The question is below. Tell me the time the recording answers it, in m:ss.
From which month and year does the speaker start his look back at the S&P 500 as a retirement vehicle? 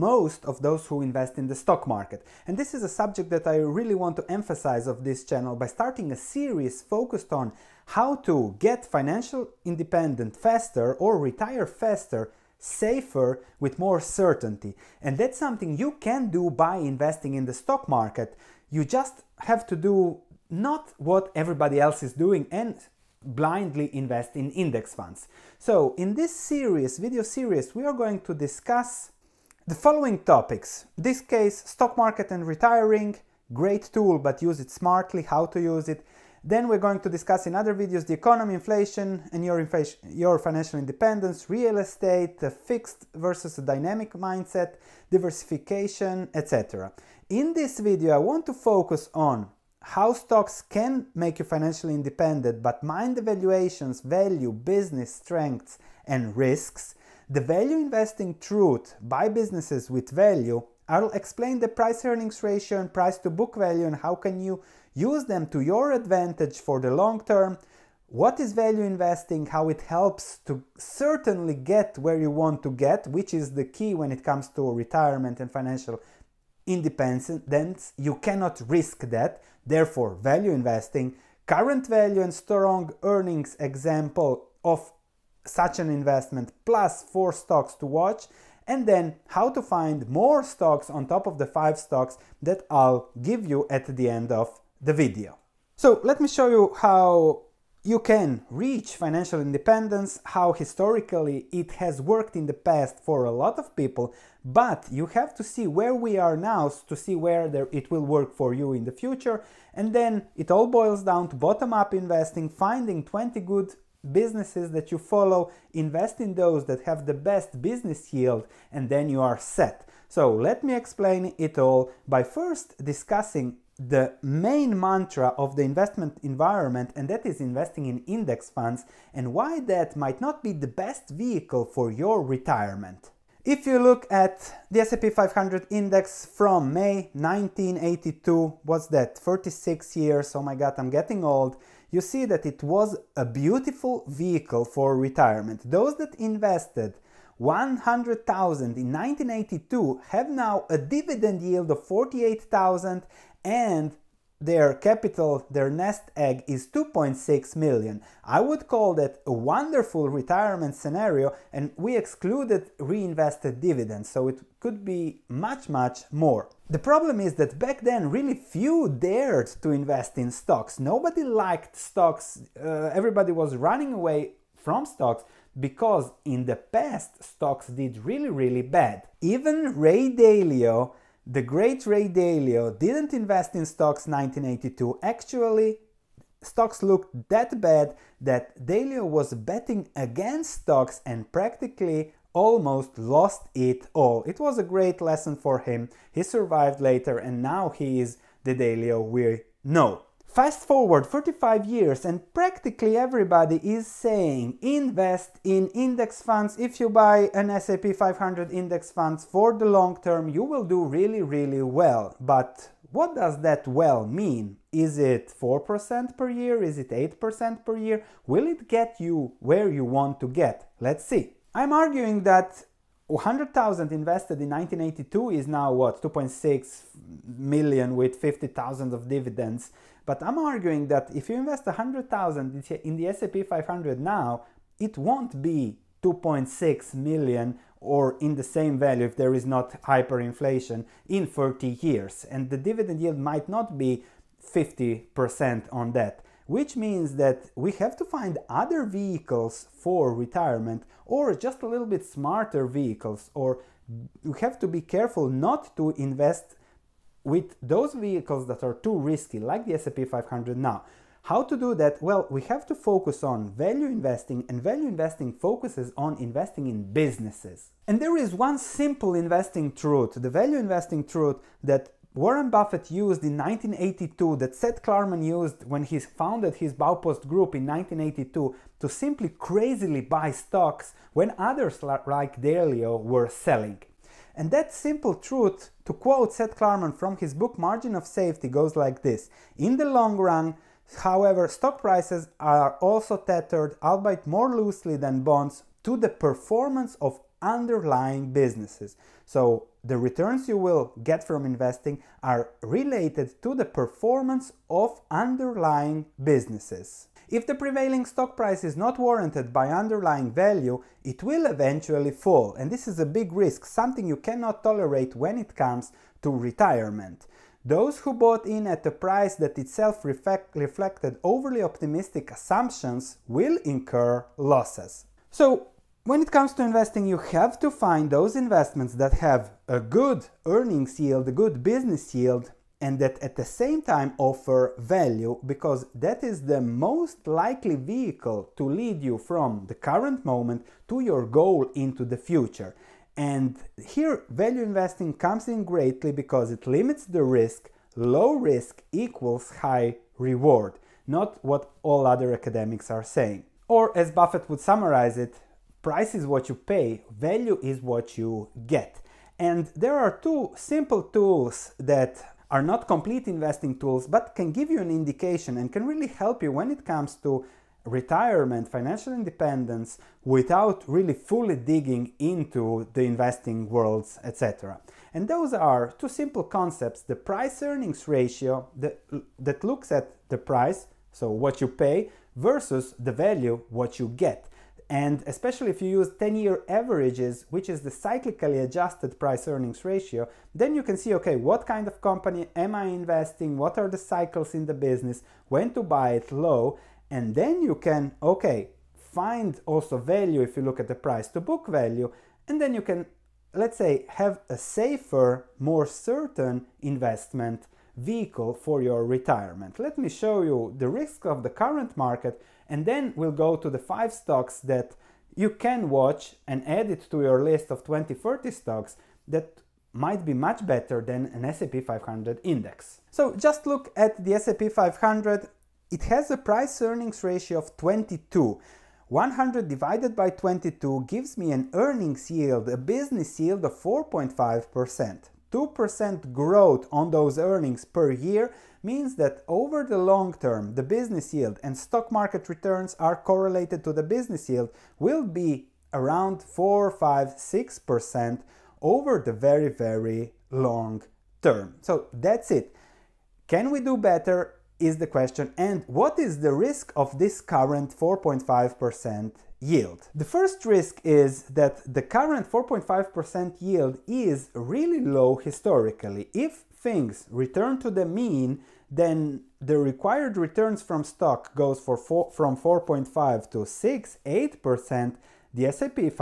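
2:16.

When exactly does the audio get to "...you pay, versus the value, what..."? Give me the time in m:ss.
6:21.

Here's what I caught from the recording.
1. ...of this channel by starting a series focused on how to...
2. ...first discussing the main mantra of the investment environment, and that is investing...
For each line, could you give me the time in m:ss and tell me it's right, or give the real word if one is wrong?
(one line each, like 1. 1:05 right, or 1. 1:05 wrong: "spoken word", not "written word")
1. 0:04 right
2. 2:02 right.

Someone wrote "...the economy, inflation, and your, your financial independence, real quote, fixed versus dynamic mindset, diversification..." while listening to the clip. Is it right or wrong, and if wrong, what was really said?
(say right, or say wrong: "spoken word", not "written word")
wrong: "estate", not "quote".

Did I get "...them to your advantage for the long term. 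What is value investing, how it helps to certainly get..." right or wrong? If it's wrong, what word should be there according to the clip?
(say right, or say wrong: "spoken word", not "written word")
right.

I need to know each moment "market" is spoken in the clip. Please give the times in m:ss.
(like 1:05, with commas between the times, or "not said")
0:01, 0:17, 0:31, 6:51, 7:22.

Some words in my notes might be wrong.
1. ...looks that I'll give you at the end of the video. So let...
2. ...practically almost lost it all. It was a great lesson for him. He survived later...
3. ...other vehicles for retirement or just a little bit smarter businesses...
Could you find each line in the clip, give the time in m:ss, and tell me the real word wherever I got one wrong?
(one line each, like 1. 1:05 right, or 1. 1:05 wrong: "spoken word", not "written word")
1. 1:31 wrong: "stocks", not "looks"
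2. 3:11 right
3. 4:08 wrong: "vehicles", not "businesses".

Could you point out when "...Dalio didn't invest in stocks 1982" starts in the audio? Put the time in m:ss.
3:02.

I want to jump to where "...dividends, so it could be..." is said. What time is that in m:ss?
2:43.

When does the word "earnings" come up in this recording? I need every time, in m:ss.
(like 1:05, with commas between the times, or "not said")
1:02, 1:23, 5:30, 6:17, 6:29, 7:06, 7:11, 7:17.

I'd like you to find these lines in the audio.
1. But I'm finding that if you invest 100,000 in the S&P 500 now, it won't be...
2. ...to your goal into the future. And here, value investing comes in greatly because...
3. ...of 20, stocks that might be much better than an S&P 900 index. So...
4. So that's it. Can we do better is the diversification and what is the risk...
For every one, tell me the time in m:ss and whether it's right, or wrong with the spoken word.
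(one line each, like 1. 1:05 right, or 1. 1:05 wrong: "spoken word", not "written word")
1. 3:50 wrong: "arguing", not "finding"
2. 5:40 right
3. 6:57 wrong: "500", not "900"
4. 7:31 wrong: "question", not "diversification".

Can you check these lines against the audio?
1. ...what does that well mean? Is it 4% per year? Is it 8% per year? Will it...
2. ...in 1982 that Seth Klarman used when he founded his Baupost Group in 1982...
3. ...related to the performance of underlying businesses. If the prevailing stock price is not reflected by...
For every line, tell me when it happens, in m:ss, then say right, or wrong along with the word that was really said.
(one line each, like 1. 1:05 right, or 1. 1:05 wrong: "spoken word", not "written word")
1. 3:32 right
2. 4:33 right
3. 5:02 wrong: "warranted", not "reflected".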